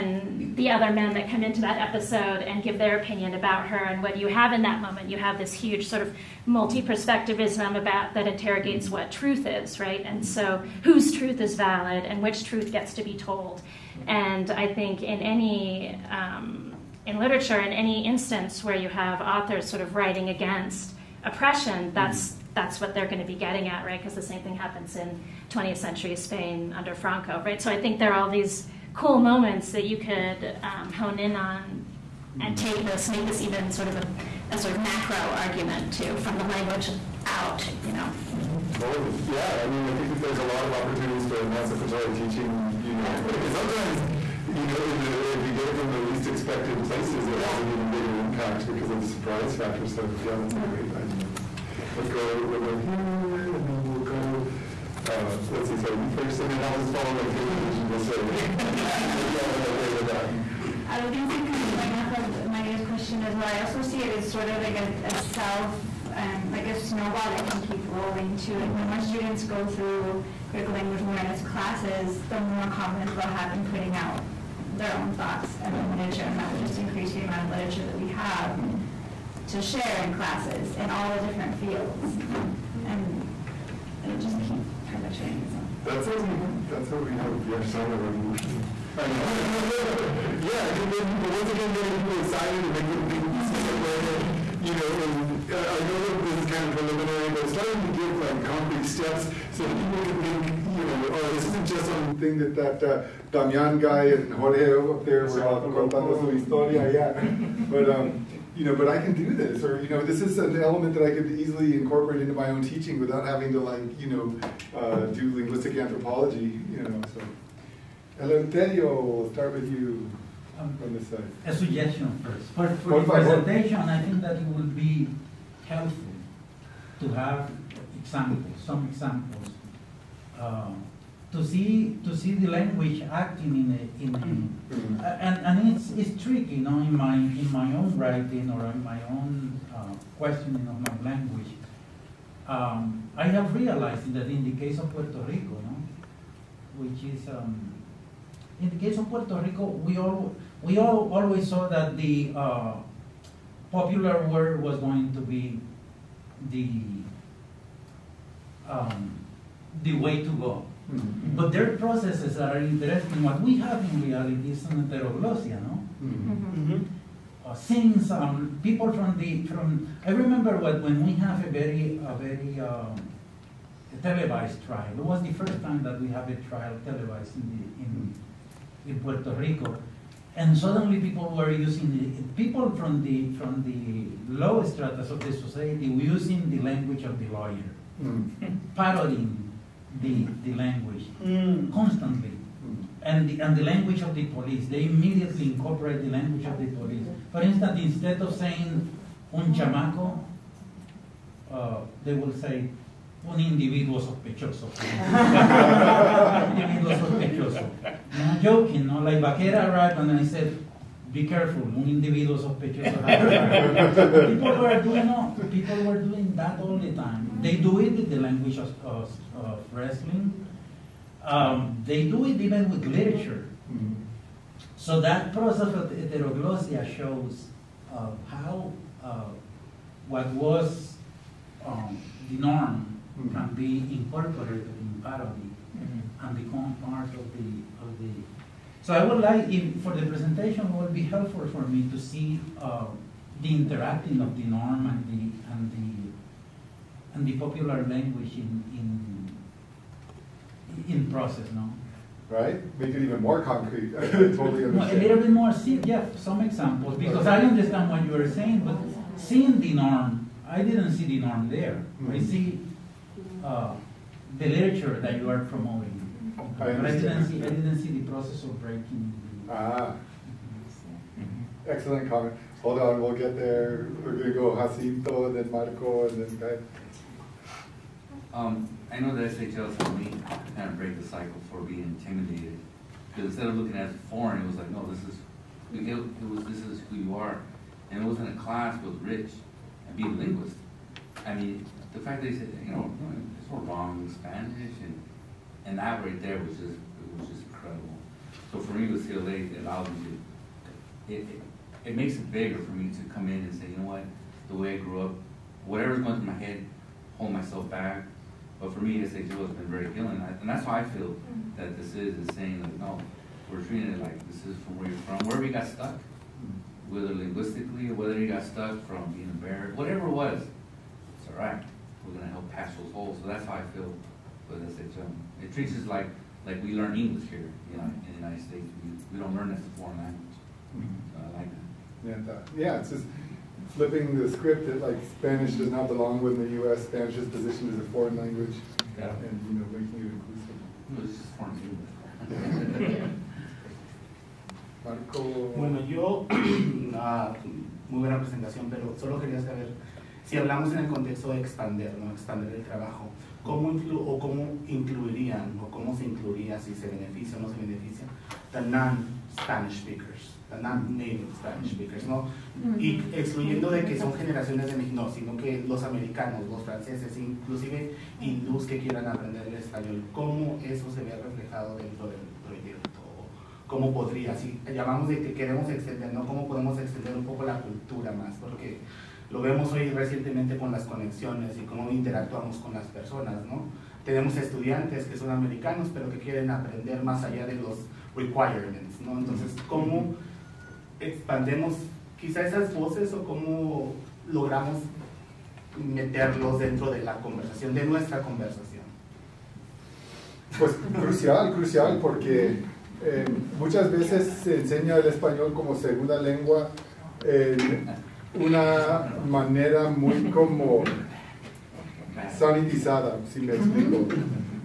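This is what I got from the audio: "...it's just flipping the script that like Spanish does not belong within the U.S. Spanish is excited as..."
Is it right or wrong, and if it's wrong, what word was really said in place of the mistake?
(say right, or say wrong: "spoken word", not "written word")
wrong: "positioned", not "excited".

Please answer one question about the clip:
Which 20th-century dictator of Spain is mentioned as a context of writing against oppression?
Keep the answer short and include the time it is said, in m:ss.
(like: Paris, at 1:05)
Franco, at 0:26.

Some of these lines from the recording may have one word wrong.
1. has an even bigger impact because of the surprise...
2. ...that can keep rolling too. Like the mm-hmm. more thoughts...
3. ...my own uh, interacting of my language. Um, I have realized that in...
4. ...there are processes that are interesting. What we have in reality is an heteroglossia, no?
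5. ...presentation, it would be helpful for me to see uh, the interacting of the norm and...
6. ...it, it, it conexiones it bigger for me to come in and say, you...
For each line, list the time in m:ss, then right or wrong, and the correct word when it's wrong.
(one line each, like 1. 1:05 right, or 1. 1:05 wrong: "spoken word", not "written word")
1. 0:47 right
2. 1:07 wrong: "students", not "thoughts"
3. 2:18 wrong: "questioning", not "interacting"
4. 2:41 right
5. 4:00 right
6. 5:01 wrong: "makes", not "conexiones".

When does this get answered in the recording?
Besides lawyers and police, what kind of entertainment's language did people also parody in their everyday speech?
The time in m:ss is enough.
3:39.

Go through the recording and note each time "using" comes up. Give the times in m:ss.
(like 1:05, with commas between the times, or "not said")
3:01, 3:06.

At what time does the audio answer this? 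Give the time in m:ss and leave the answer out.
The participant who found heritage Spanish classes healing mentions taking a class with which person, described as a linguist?
4:49.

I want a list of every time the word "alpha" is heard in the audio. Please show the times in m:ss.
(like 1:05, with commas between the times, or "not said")
not said.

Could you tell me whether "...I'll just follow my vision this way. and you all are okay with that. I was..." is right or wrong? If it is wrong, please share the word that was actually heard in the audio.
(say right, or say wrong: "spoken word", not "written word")
right.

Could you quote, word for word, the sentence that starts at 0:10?
And so whose truth is valid and which truth gets to be told.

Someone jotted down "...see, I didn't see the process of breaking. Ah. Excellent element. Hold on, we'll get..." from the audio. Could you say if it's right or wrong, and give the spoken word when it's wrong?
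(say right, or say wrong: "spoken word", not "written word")
wrong: "comment", not "element".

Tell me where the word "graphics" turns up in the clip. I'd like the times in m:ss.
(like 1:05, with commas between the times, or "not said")
not said.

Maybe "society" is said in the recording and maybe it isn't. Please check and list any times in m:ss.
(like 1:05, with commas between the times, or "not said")
3:05.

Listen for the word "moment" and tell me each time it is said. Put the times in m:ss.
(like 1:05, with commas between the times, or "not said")
0:04, 0:29.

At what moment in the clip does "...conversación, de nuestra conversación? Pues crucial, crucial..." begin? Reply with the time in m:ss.
6:37.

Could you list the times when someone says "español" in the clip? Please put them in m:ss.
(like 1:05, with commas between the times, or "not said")
6:09, 6:45.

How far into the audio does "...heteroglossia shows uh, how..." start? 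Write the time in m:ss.
3:45.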